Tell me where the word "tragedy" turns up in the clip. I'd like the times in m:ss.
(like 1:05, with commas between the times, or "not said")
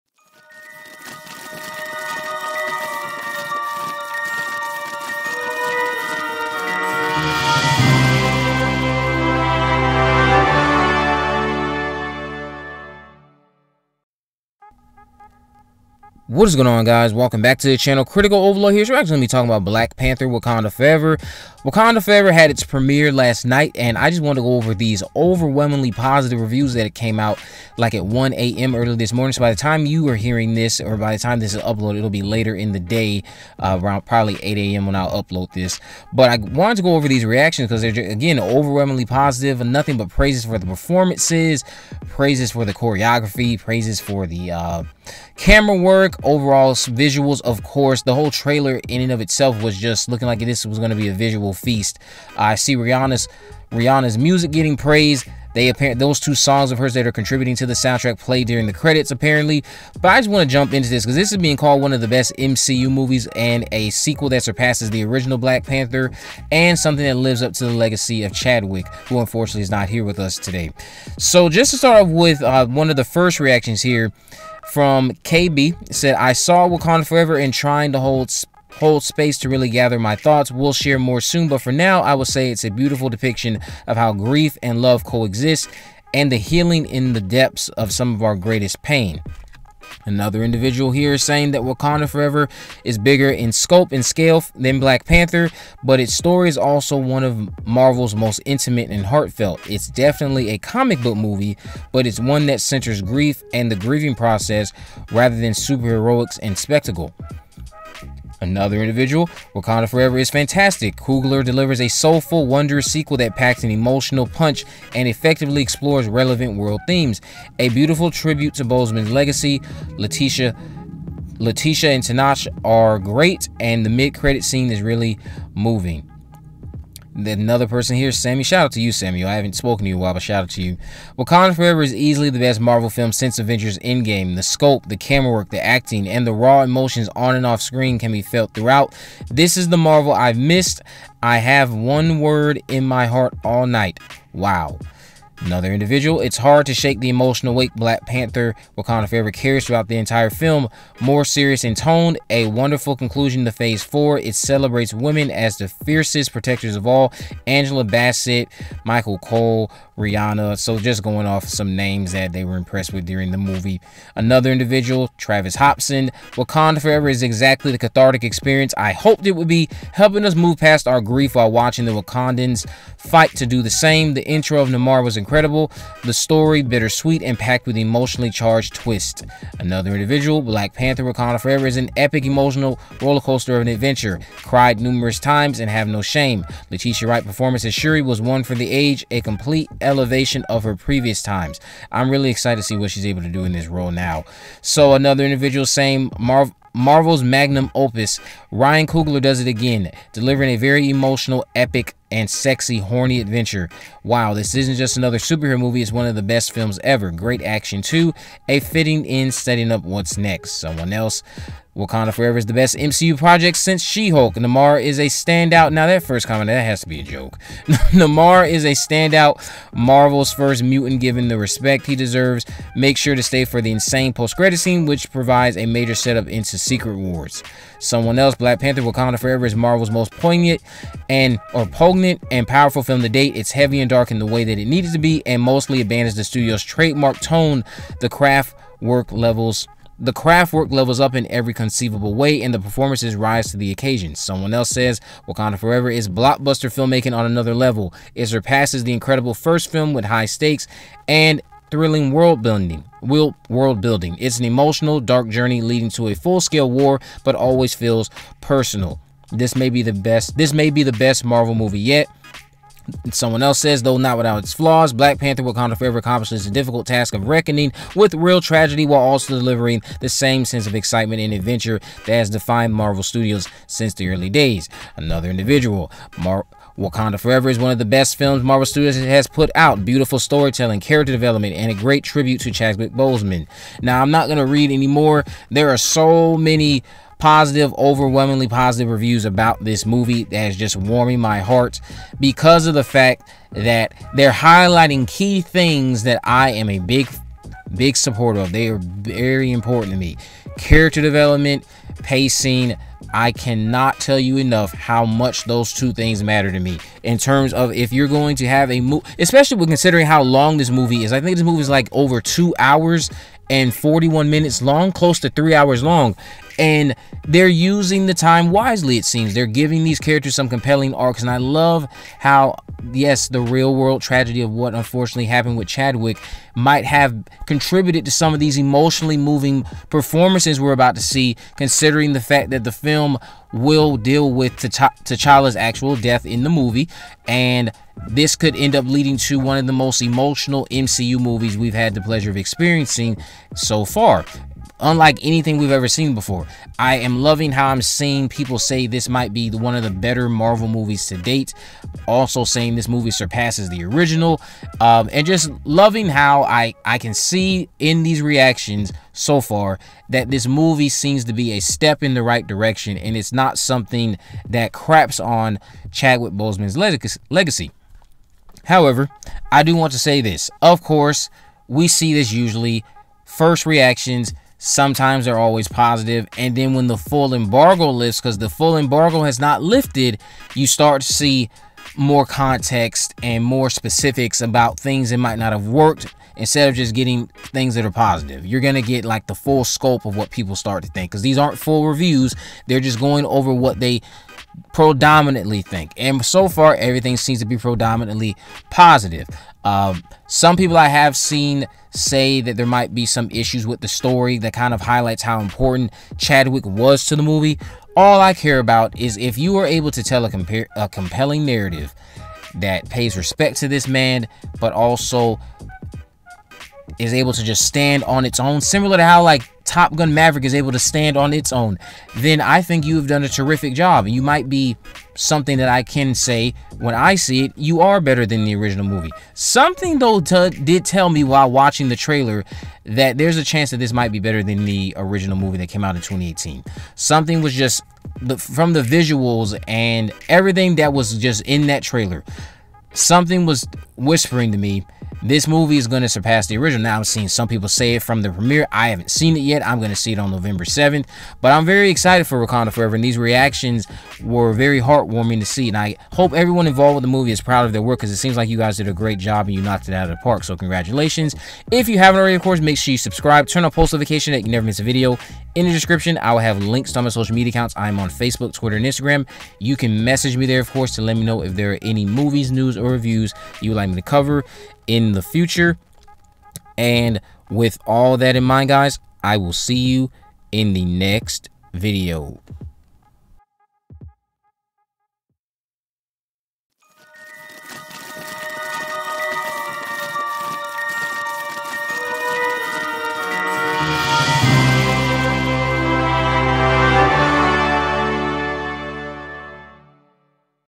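4:28, 5:24.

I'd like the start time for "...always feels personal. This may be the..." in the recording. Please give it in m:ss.
4:17.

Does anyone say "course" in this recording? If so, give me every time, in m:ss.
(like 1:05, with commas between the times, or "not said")
0:47, 6:10, 7:42, 7:50.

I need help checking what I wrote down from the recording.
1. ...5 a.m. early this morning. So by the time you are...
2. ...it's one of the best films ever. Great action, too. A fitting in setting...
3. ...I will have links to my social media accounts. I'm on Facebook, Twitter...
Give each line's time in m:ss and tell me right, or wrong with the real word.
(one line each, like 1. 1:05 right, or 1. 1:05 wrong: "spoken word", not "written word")
1. 0:28 wrong: "1", not "5"
2. 3:25 right
3. 7:46 right.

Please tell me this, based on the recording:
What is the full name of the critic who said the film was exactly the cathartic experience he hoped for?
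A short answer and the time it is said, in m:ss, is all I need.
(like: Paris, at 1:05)
Travis Hobson, at 2:45.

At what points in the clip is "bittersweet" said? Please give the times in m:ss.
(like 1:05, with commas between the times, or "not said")
2:56.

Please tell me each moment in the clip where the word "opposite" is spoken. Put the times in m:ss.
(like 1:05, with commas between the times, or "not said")
not said.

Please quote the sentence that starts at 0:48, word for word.
The whole trailer in and of itself was just looking like this was going to be a visual feast.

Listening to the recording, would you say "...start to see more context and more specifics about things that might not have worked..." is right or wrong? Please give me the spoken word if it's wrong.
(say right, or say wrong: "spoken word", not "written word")
right.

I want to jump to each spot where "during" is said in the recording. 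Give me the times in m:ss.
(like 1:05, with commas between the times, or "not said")
0:58, 2:43.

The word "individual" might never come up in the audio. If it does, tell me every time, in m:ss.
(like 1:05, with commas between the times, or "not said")
1:30, 1:48, 2:25, 2:44, 2:59, 3:15, 4:35.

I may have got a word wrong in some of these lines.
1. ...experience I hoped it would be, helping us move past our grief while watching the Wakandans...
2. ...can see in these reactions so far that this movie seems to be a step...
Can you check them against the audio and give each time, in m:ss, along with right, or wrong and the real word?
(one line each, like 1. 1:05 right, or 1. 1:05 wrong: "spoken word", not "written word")
1. 2:48 right
2. 5:56 right.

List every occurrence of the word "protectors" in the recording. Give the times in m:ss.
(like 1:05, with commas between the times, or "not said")
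2:36.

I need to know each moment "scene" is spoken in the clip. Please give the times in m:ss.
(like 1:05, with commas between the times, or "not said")
2:04, 3:44.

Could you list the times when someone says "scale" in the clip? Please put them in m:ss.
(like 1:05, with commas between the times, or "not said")
1:34, 4:16.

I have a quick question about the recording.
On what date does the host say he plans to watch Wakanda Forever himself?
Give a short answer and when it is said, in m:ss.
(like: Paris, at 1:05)
November 7th, at 7:30.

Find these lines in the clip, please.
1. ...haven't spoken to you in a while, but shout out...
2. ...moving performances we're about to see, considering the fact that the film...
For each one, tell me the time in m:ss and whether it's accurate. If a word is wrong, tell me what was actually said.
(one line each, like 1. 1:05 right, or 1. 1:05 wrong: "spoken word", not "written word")
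1. 2:09 right
2. 5:29 right.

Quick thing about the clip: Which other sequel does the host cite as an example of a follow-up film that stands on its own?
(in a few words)
Top Gun Maverick.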